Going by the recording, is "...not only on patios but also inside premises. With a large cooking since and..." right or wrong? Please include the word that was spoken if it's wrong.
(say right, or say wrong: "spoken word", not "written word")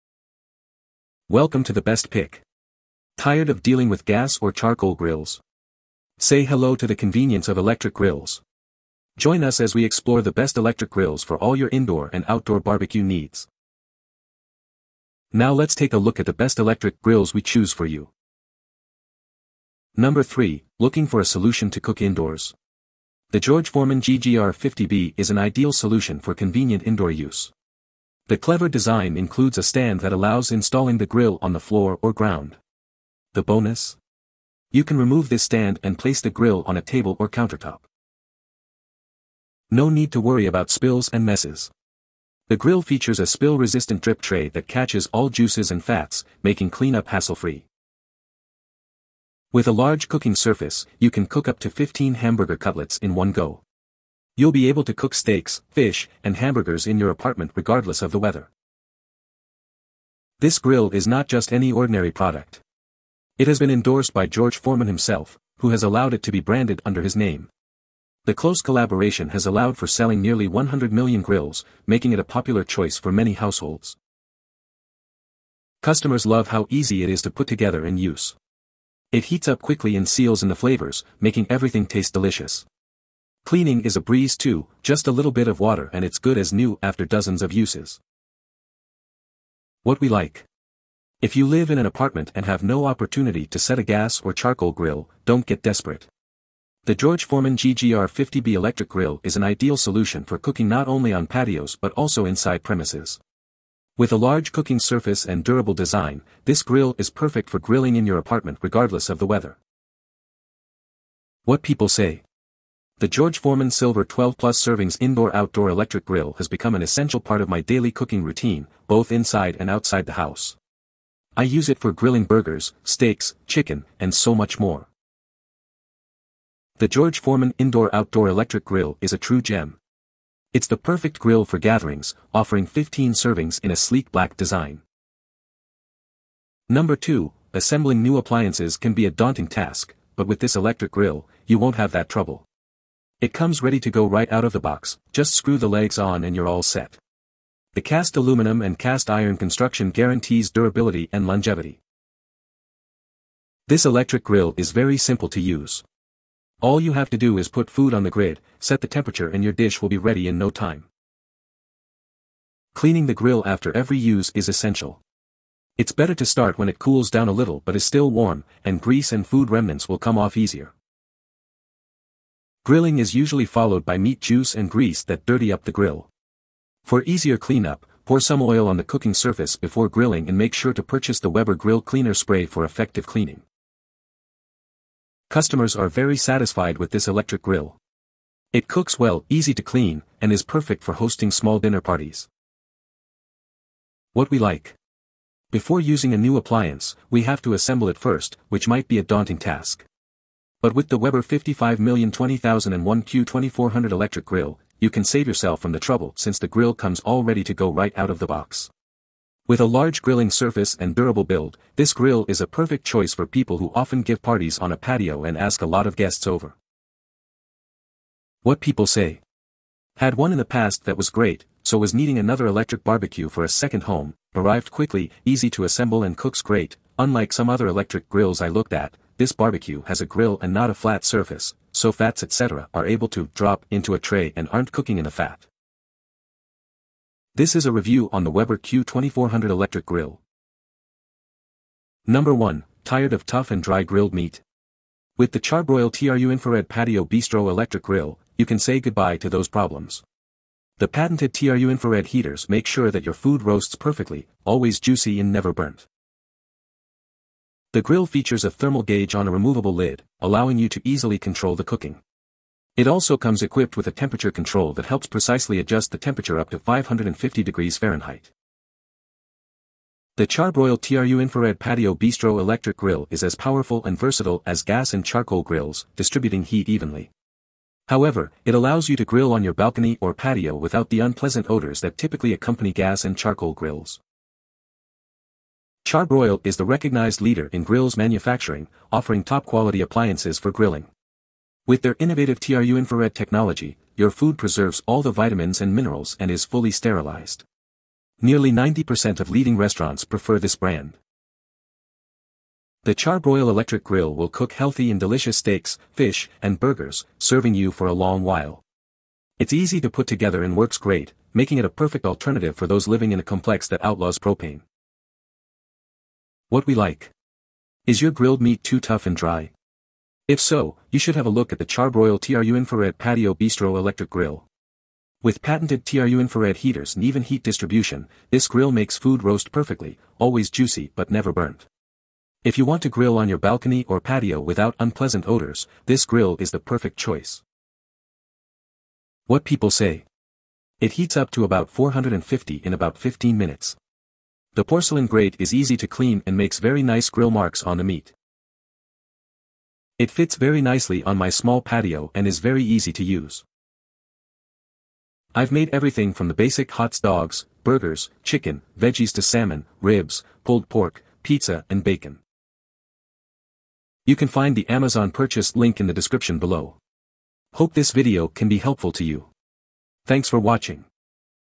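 wrong: "surface", not "since".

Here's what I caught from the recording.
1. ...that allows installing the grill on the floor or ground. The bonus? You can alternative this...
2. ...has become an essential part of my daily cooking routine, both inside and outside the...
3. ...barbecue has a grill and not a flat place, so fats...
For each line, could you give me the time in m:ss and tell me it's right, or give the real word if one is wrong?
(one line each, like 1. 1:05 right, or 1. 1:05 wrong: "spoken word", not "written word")
1. 0:29 wrong: "remove", not "alternative"
2. 1:56 right
3. 3:49 wrong: "surface", not "place".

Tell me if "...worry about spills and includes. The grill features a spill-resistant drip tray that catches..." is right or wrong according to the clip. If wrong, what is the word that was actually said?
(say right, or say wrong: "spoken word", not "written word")
wrong: "messes", not "includes".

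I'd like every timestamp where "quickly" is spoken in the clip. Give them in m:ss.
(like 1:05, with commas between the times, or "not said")
1:19, 3:44.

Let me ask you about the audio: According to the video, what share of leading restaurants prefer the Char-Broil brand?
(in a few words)
nearly 90%.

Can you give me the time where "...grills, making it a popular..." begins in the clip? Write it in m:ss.
1:11.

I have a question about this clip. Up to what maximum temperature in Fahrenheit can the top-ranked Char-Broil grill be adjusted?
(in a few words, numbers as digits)
550 degrees.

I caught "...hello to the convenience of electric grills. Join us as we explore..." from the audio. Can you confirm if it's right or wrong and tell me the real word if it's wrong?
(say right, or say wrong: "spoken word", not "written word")
right.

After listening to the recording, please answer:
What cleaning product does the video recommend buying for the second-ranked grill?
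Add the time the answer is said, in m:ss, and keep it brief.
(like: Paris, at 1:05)
Weber Grill Cleaner Spray, at 3:01.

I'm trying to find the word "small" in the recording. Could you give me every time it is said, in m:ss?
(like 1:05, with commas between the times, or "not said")
3:11, 5:51.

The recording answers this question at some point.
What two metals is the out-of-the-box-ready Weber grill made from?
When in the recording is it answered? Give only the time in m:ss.
2:27.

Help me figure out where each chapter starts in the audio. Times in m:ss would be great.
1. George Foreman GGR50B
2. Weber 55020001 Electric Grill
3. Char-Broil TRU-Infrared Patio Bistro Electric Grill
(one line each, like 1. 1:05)
1. 0:18
2. 2:15
3. 4:00.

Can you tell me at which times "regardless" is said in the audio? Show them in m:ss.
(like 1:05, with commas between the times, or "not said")
0:57, 1:48.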